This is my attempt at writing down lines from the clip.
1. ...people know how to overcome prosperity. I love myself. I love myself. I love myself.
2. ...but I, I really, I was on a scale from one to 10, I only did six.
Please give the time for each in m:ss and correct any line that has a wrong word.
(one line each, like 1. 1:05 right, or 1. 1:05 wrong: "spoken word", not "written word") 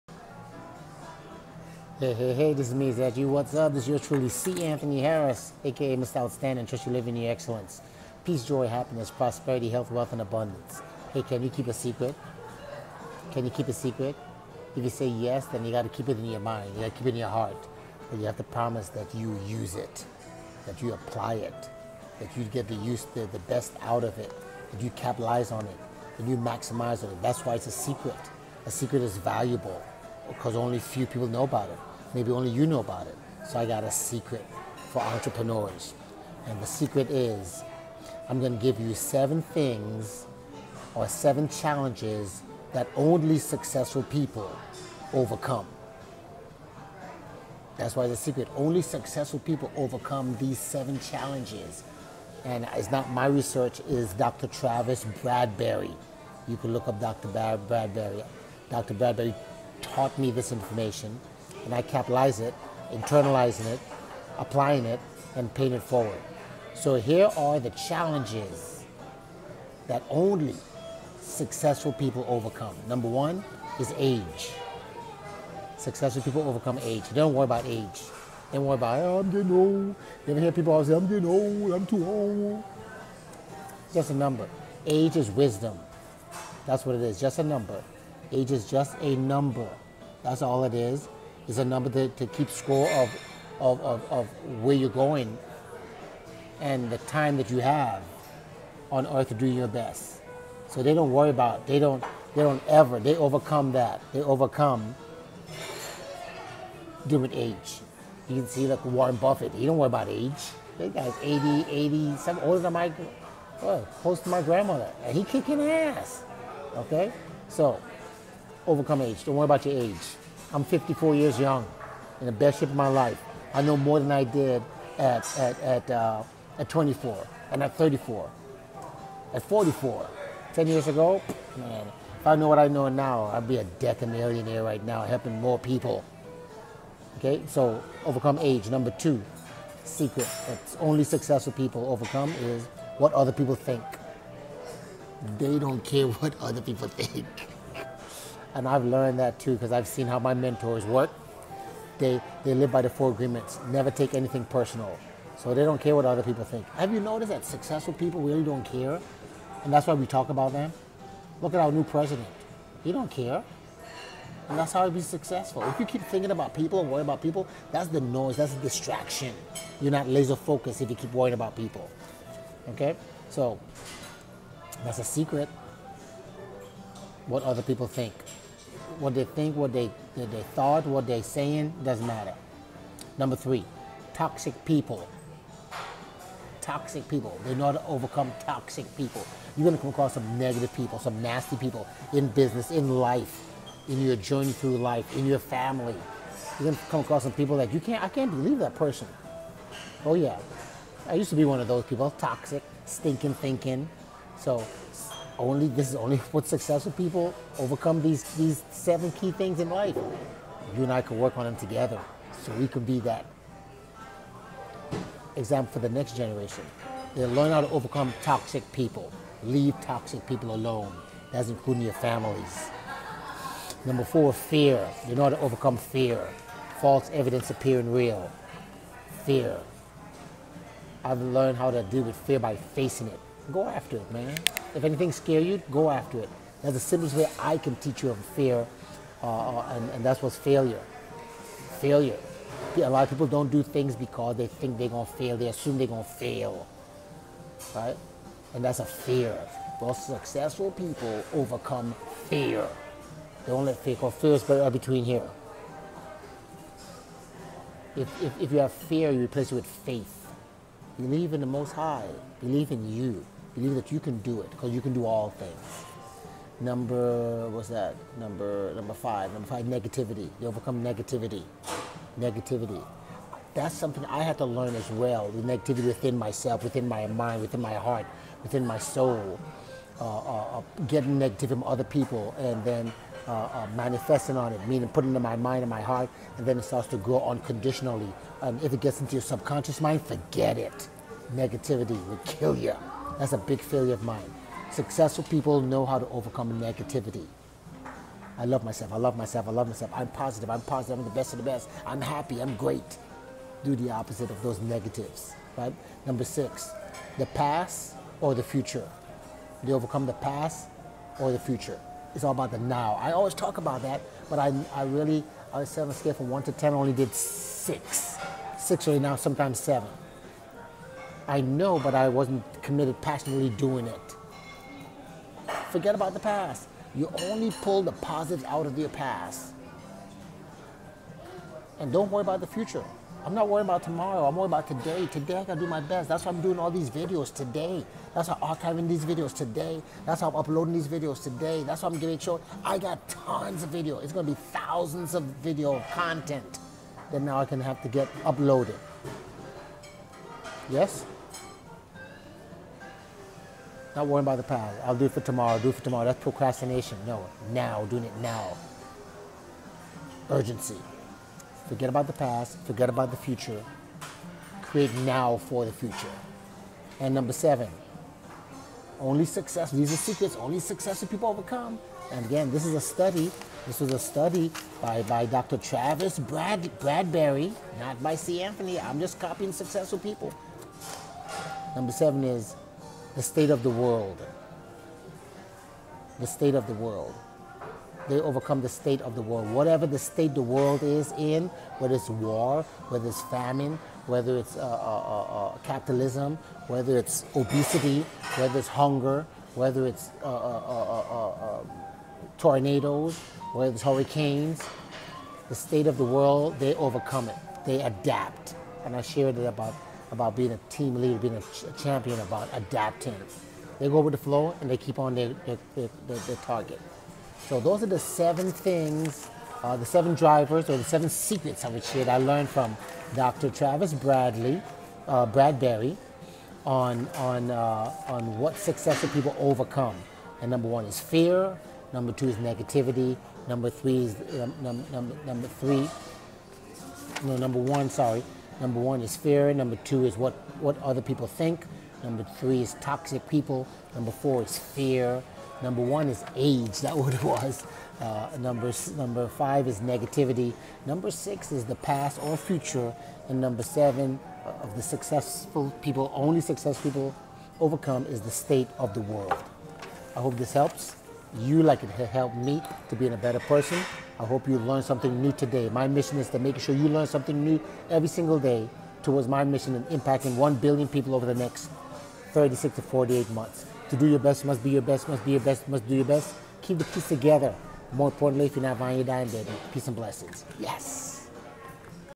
1. 4:55 wrong: "negativity", not "prosperity"
2. 5:14 right.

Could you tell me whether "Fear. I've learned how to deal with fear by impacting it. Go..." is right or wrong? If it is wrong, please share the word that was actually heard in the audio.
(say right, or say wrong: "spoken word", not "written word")
wrong: "facing", not "impacting".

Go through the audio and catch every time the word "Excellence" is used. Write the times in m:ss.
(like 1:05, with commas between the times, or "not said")
0:07.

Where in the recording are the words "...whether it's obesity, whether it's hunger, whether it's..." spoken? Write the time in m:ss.
6:36.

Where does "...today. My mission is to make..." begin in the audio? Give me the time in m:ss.
7:45.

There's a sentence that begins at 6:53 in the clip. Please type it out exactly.
They go with the flow and they keep on their, their, their, their, their target.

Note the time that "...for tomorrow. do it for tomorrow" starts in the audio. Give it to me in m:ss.
5:55.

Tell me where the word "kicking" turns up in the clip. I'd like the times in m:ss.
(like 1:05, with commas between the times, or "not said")
1:55.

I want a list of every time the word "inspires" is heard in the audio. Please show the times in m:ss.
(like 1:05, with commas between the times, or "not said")
not said.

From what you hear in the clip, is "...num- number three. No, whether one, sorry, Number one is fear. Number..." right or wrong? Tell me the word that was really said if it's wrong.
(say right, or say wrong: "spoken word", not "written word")
wrong: "number", not "whether".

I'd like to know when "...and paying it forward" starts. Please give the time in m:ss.
1:05.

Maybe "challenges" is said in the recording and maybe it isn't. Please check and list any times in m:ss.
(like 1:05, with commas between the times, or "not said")
0:41, 0:50, 1:07.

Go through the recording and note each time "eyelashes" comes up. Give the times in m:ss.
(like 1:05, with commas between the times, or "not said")
not said.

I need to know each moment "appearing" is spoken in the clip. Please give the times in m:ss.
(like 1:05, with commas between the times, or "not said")
3:47.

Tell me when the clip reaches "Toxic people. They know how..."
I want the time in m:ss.
3:06.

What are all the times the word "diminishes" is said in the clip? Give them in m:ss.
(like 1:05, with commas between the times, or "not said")
not said.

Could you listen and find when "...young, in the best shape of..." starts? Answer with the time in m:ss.
2:01.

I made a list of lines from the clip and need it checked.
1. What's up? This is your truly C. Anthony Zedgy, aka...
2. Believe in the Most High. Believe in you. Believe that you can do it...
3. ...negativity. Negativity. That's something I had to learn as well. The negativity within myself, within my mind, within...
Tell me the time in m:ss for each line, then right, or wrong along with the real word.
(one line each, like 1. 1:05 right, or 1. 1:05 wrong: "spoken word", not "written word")
1. 0:03 wrong: "Harris", not "Zedgy"
2. 4:20 right
3. 4:30 right.